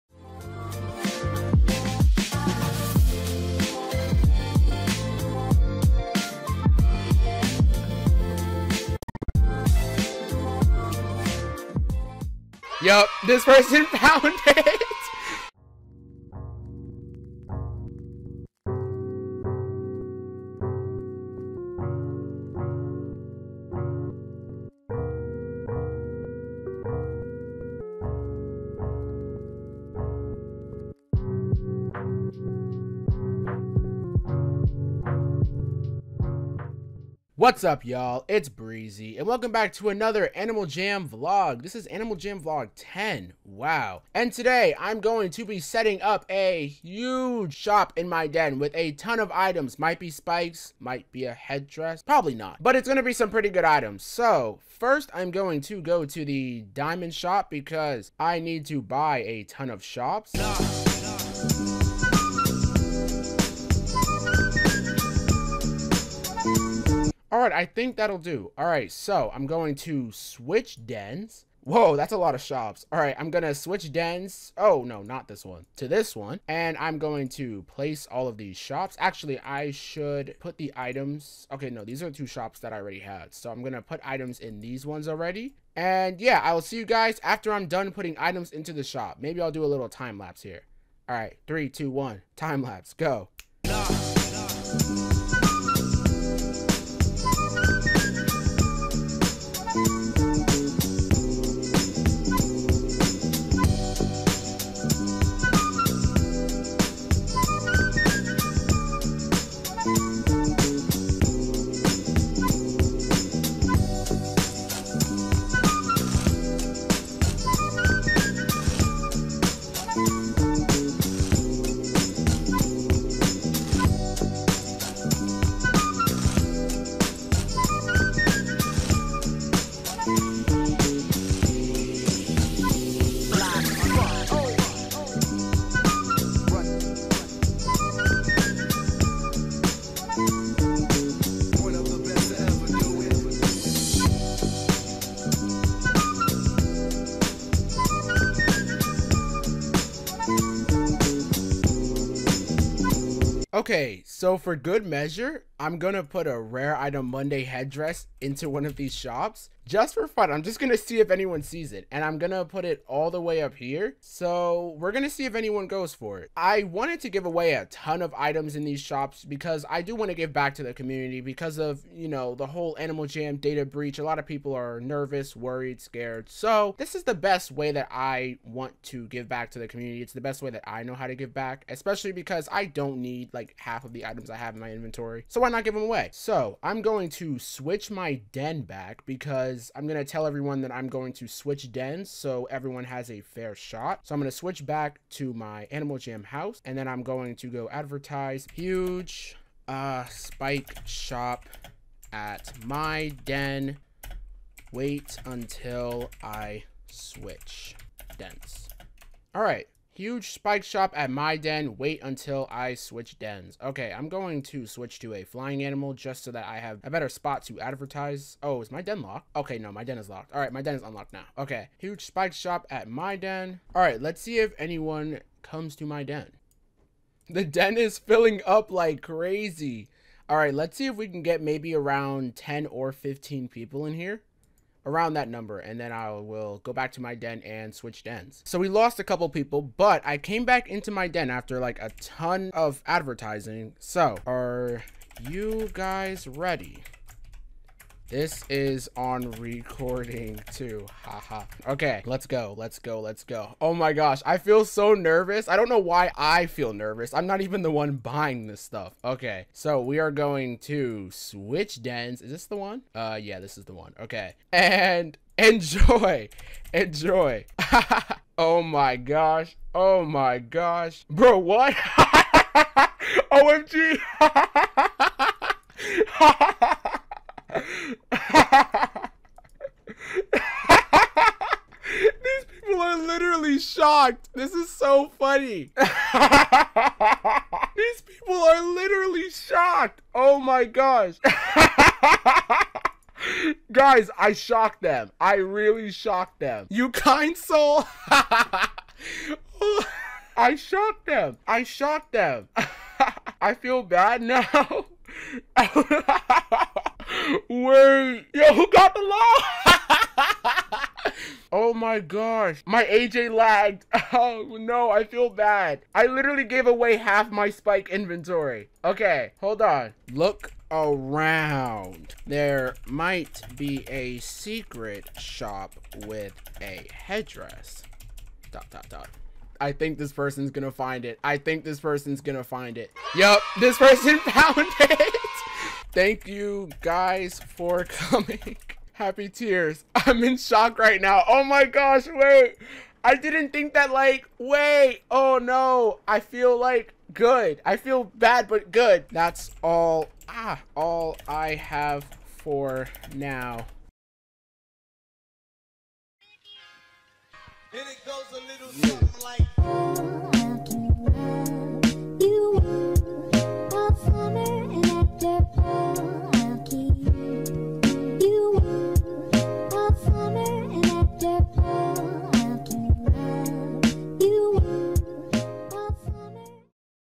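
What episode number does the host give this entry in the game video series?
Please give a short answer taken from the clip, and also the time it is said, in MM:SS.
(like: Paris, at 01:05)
10, at 00:41.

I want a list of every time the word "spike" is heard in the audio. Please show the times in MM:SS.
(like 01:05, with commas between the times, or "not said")
00:50, 03:20, 03:30, 03:42, 05:17.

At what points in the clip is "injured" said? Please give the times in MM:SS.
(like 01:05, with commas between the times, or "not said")
not said.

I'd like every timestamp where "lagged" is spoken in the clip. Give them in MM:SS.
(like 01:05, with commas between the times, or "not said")
05:13.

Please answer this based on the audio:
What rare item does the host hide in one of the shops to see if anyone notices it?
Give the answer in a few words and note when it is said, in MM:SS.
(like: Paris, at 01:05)
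rare item Monday headdress, at 02:36.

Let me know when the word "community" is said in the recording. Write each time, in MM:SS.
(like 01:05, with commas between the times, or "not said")
02:50, 02:59.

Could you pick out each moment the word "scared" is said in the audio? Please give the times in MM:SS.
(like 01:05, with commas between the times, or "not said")
02:55.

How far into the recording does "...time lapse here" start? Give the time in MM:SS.
01:29.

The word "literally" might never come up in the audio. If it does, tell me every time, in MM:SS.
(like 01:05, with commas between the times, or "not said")
04:43, 04:48, 05:16.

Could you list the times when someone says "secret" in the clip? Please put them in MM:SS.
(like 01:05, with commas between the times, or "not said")
05:24.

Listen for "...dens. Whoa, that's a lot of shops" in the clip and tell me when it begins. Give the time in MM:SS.
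01:10.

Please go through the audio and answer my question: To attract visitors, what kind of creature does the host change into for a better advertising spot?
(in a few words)
flying animal.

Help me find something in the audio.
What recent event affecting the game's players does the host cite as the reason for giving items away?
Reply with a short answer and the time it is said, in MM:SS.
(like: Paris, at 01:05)
data breach, at 02:53.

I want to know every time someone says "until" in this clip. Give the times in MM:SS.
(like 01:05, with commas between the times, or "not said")
03:25, 03:32.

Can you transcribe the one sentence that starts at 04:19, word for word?
Okay, so we are going to switch dens.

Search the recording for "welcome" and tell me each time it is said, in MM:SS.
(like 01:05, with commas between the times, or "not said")
00:39.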